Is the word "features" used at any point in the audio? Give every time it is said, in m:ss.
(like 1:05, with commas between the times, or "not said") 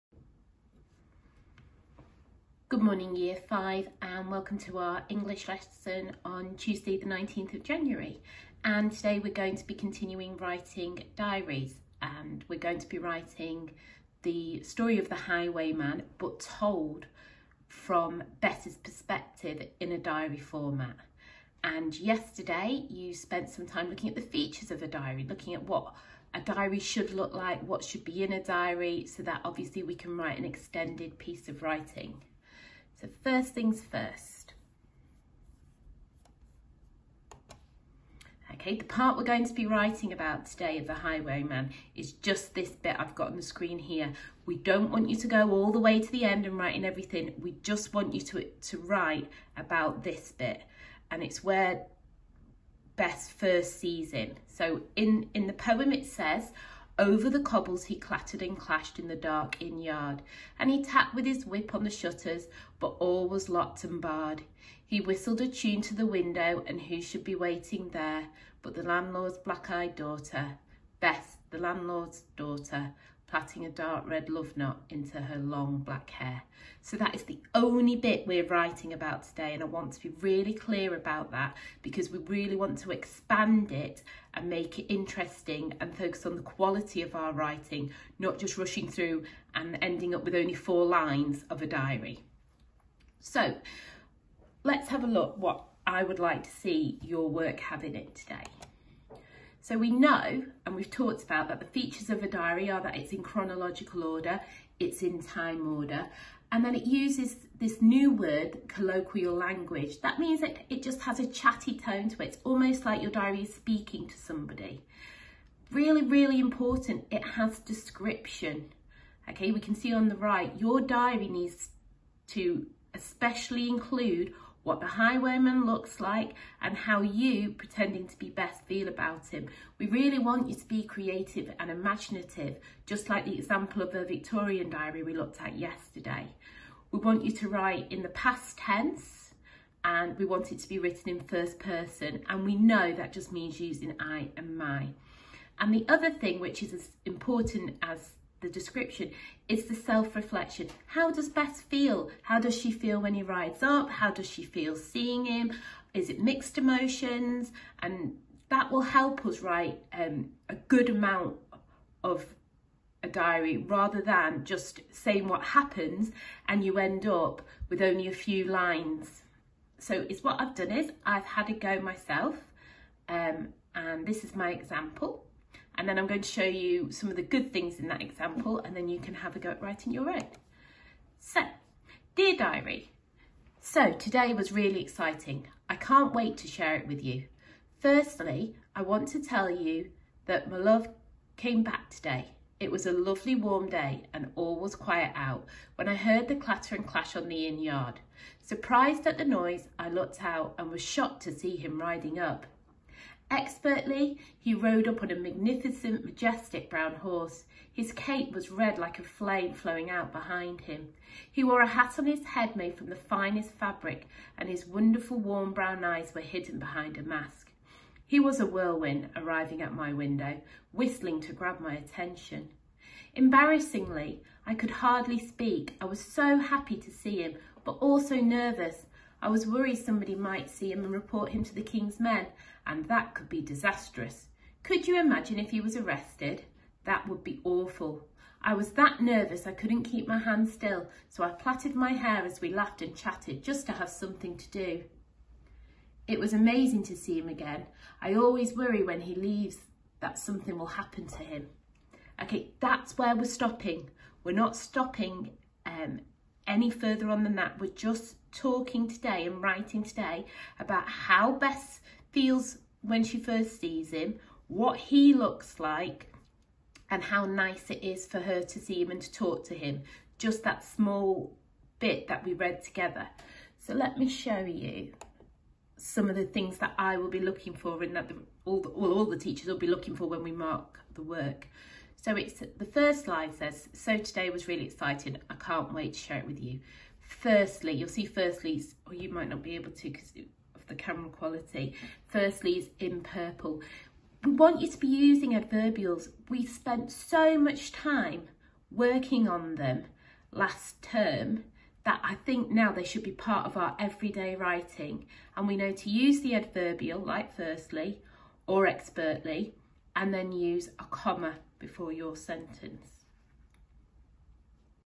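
0:24, 1:41.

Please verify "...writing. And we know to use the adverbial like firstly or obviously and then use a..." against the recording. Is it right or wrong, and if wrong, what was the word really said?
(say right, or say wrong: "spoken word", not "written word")
wrong: "expertly", not "obviously".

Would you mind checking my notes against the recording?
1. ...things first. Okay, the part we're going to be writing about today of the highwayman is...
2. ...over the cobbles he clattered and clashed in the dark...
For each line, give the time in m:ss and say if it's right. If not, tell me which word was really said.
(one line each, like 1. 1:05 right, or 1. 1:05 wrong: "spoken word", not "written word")
1. 0:33 right
2. 0:57 right.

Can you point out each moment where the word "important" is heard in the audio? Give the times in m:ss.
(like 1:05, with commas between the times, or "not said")
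1:56, 2:27.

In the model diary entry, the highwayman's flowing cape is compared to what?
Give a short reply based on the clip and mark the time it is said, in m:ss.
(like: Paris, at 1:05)
A flame, at 3:28.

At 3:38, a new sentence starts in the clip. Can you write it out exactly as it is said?
He was a whirlwind, arriving at my window, whistling to grab my attention.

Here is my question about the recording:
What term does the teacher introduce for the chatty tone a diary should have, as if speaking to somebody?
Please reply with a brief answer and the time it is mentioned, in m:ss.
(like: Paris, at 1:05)
Colloquial language, at 1:48.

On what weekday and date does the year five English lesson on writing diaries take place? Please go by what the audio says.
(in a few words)
Tuesday 19th January.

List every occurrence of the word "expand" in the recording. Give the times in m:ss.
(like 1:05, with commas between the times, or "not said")
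1:22.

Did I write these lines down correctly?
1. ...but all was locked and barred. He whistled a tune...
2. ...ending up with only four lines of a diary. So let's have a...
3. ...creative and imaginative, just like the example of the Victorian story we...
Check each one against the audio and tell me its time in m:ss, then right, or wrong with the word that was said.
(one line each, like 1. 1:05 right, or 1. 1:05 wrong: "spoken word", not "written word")
1. 1:02 right
2. 1:29 right
3. 2:10 wrong: "diary", not "story".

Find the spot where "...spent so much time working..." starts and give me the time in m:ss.
4:56.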